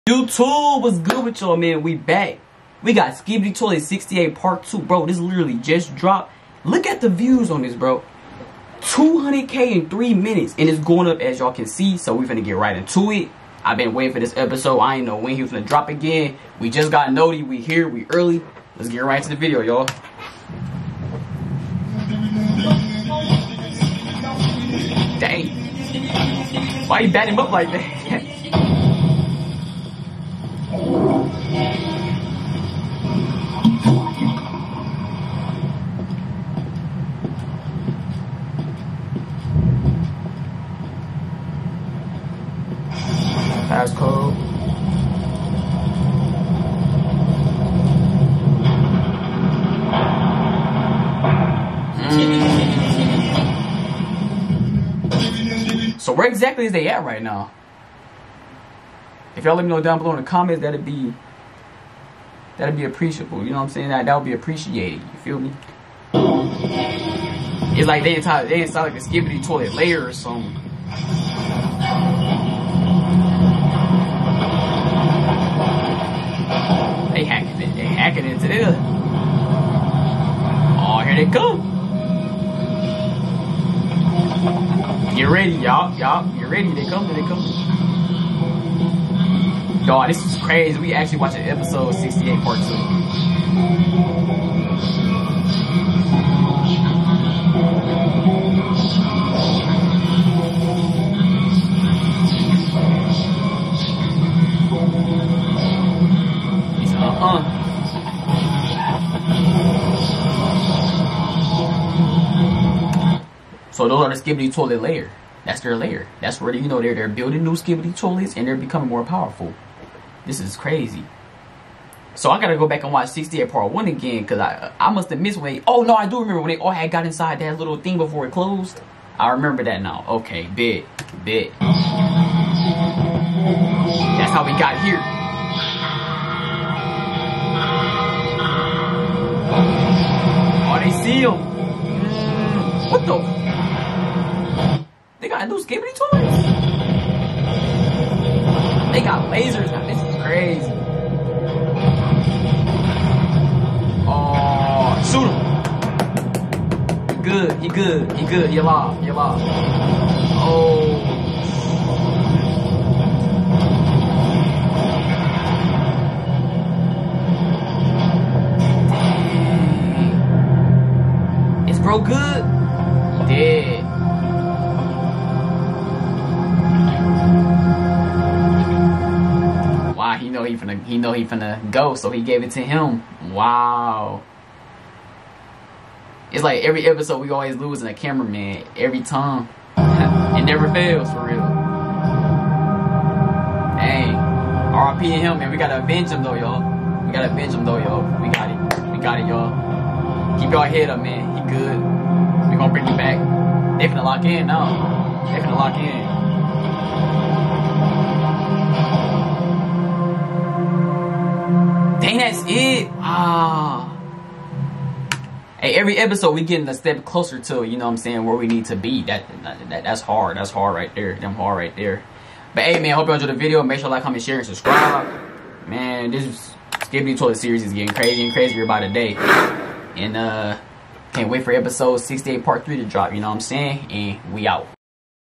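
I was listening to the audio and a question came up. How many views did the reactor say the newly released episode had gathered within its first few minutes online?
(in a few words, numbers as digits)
200K.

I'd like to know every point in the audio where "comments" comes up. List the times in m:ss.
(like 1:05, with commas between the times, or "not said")
1:00, 3:44.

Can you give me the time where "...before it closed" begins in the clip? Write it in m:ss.
2:07.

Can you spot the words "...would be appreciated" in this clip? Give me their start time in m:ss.
1:04.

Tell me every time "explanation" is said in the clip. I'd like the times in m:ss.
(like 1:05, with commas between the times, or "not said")
not said.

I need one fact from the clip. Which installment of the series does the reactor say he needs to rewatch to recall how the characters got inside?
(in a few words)
68 part 1.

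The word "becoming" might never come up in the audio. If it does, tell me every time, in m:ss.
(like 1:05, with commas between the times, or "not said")
1:58.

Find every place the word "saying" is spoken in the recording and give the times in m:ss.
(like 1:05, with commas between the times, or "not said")
1:03, 3:37, 3:53.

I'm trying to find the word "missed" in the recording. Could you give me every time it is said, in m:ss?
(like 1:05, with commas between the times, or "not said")
2:05.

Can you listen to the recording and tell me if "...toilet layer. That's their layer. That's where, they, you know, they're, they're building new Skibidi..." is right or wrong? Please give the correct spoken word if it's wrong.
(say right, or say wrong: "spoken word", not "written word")
right.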